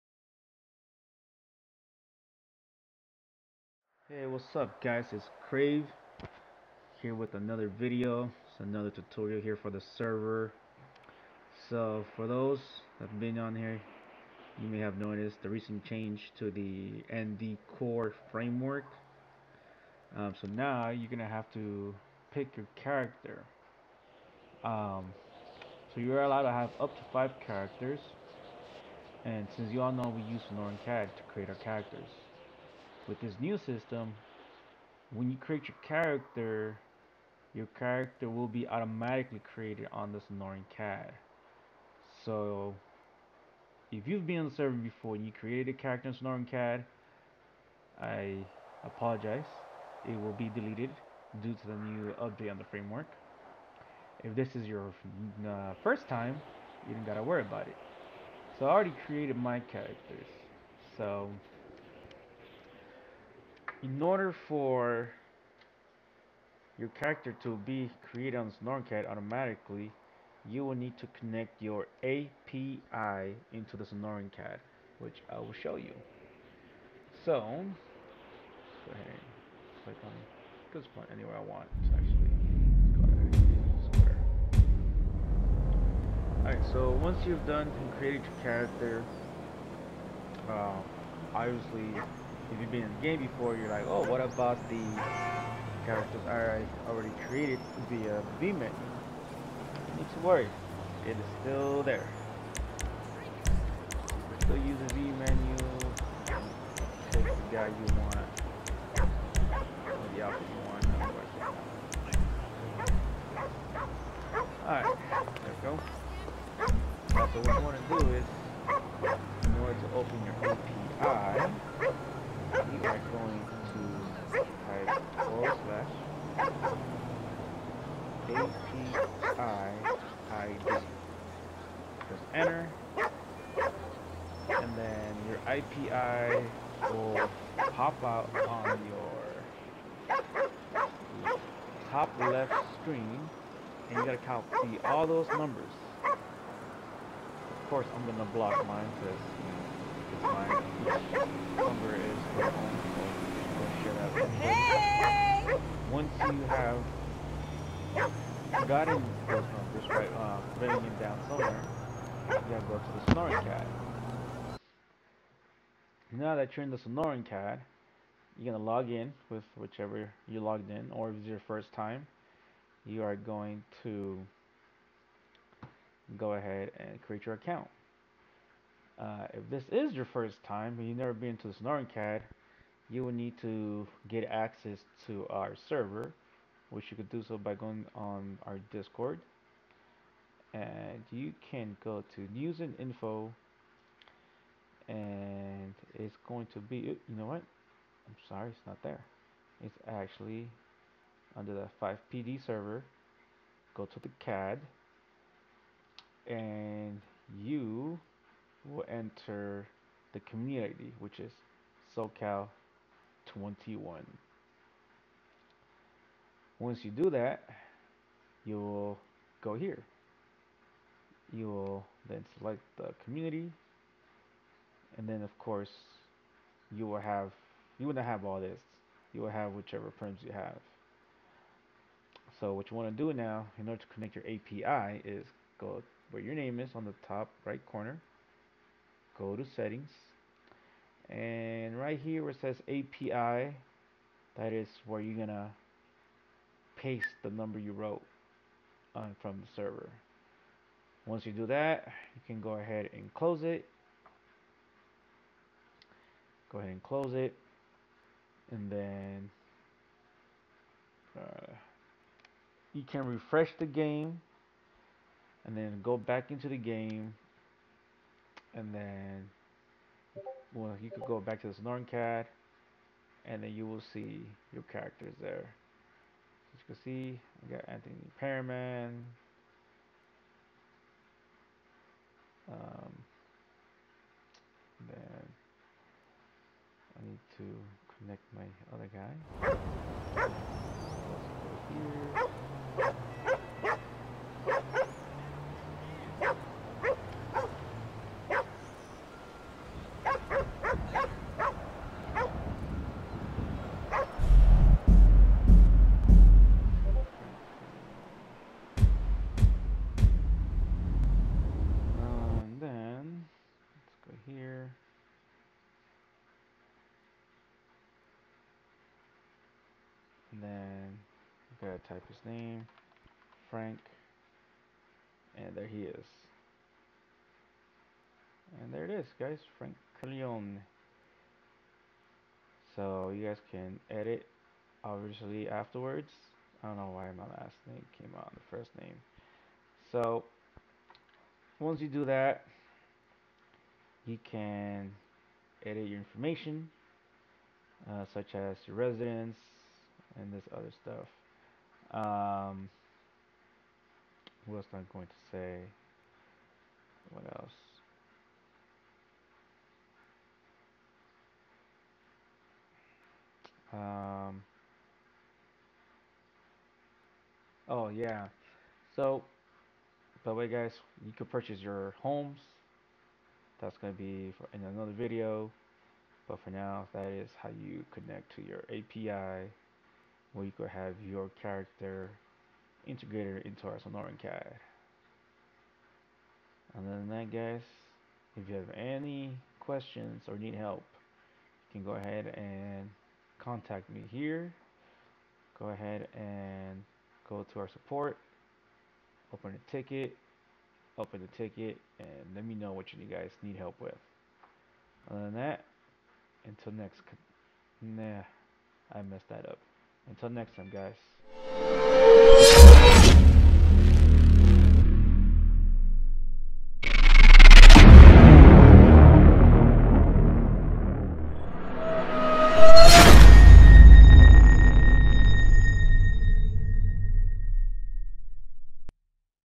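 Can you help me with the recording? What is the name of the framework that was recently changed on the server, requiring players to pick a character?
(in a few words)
ND Core.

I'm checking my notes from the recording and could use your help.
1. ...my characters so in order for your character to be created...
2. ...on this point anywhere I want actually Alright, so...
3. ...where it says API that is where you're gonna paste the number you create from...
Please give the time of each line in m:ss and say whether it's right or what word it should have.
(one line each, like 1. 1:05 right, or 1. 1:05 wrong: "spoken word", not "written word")
1. 0:59 right
2. 1:20 right
3. 4:02 wrong: "wrote", not "create".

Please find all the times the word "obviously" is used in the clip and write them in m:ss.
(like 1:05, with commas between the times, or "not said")
1:31, 5:34.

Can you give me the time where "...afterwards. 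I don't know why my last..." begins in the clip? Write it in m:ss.
5:35.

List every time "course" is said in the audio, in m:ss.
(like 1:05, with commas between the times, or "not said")
2:27, 3:45.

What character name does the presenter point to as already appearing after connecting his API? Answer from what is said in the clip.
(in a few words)
Anthony Perriman.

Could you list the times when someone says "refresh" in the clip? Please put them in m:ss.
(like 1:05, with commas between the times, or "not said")
4:23.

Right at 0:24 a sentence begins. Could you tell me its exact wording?
Um, so you're allowed to have up to five characters.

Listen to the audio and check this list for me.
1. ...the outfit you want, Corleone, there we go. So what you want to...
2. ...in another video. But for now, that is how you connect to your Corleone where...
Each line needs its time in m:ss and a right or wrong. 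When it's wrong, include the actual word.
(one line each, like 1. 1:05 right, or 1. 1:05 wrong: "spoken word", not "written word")
1. 1:50 wrong: "Alright", not "Corleone"
2. 6:14 wrong: "API", not "Corleone".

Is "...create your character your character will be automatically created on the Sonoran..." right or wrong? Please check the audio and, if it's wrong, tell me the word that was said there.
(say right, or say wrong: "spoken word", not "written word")
right.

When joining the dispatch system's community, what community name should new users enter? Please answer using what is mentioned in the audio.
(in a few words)
SoCal 21.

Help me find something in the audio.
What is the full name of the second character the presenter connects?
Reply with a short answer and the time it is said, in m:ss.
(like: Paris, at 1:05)
Frank Corleone, at 5:29.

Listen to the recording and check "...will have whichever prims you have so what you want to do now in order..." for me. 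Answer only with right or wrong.
right.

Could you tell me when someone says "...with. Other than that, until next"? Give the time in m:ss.
6:43.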